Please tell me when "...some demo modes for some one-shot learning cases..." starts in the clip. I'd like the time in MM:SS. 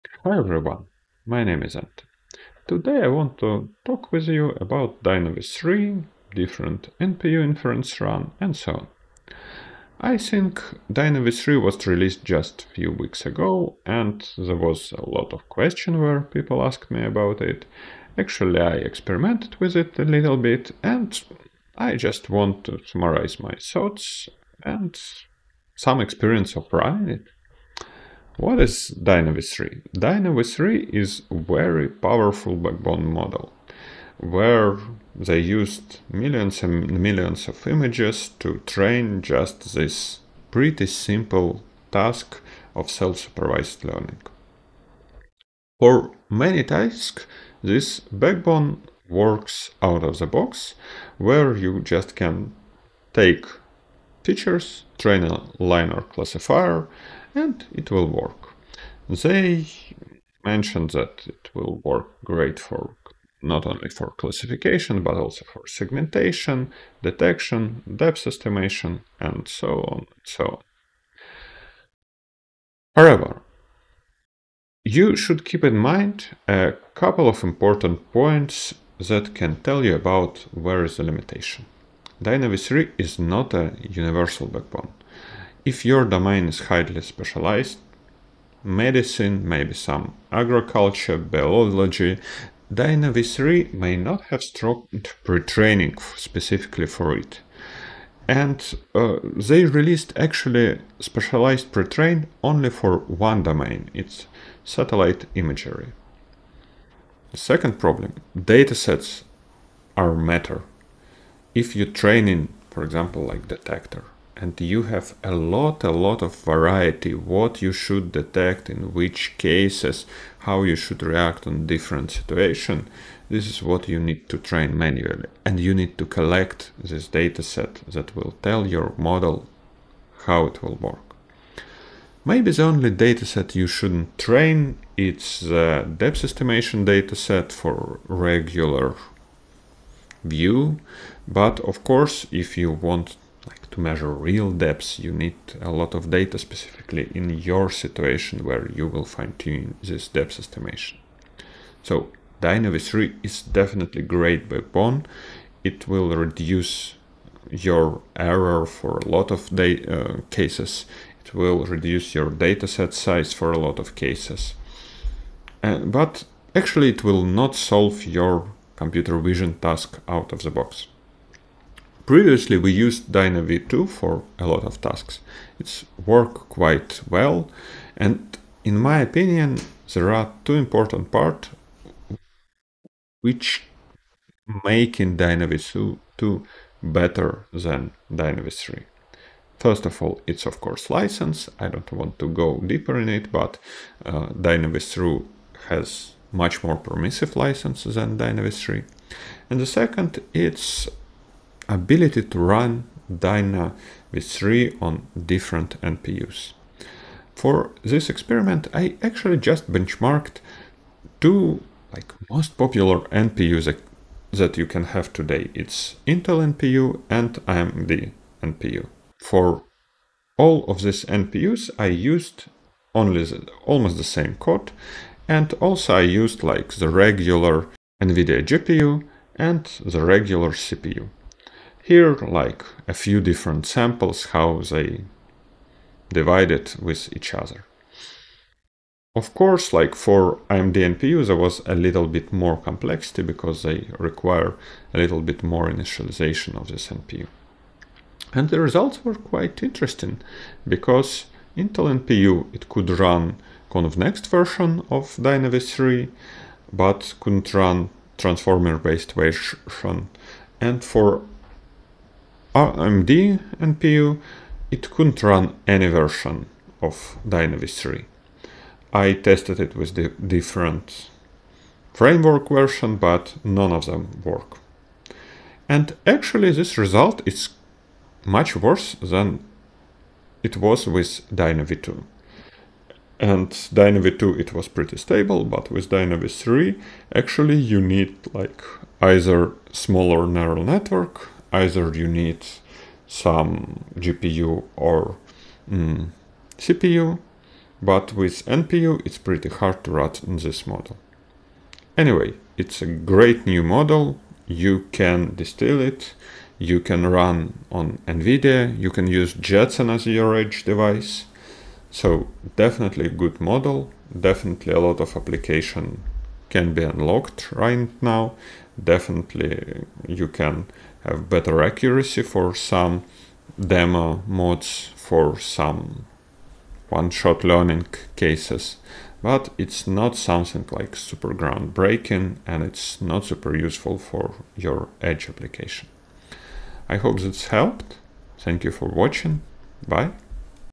05:22.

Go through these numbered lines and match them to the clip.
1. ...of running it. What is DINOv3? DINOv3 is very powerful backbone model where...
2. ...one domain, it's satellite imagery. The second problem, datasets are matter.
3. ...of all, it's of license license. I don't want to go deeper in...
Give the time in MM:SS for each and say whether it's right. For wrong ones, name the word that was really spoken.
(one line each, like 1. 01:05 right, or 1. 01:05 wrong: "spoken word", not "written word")
1. 00:26 right
2. 01:42 right
3. 03:09 wrong: "course", not "license".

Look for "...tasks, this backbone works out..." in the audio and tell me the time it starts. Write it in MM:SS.
00:46.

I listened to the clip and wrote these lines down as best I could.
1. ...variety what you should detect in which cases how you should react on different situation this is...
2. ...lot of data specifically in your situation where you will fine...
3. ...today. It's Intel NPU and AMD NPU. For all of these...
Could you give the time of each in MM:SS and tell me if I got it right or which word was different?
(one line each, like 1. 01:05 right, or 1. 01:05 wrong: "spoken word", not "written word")
1. 01:56 right
2. 02:25 right
3. 03:35 right.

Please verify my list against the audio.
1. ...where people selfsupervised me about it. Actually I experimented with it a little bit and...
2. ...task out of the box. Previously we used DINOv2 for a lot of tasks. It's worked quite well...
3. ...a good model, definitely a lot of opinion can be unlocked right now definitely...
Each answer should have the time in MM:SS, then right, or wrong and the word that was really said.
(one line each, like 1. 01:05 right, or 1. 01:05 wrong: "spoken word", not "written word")
1. 00:15 wrong: "asked", not "selfsupervised"
2. 02:49 right
3. 05:13 wrong: "application", not "opinion".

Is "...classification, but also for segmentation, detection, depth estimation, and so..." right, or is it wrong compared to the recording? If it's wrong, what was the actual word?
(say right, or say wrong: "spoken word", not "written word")
right.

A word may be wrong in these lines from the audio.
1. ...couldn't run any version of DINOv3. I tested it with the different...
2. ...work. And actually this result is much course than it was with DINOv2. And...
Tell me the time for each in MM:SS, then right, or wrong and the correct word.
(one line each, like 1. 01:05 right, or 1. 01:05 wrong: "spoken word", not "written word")
1. 04:24 right
2. 04:34 wrong: "worse", not "course".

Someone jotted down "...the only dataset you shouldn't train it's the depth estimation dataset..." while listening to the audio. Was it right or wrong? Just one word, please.
right.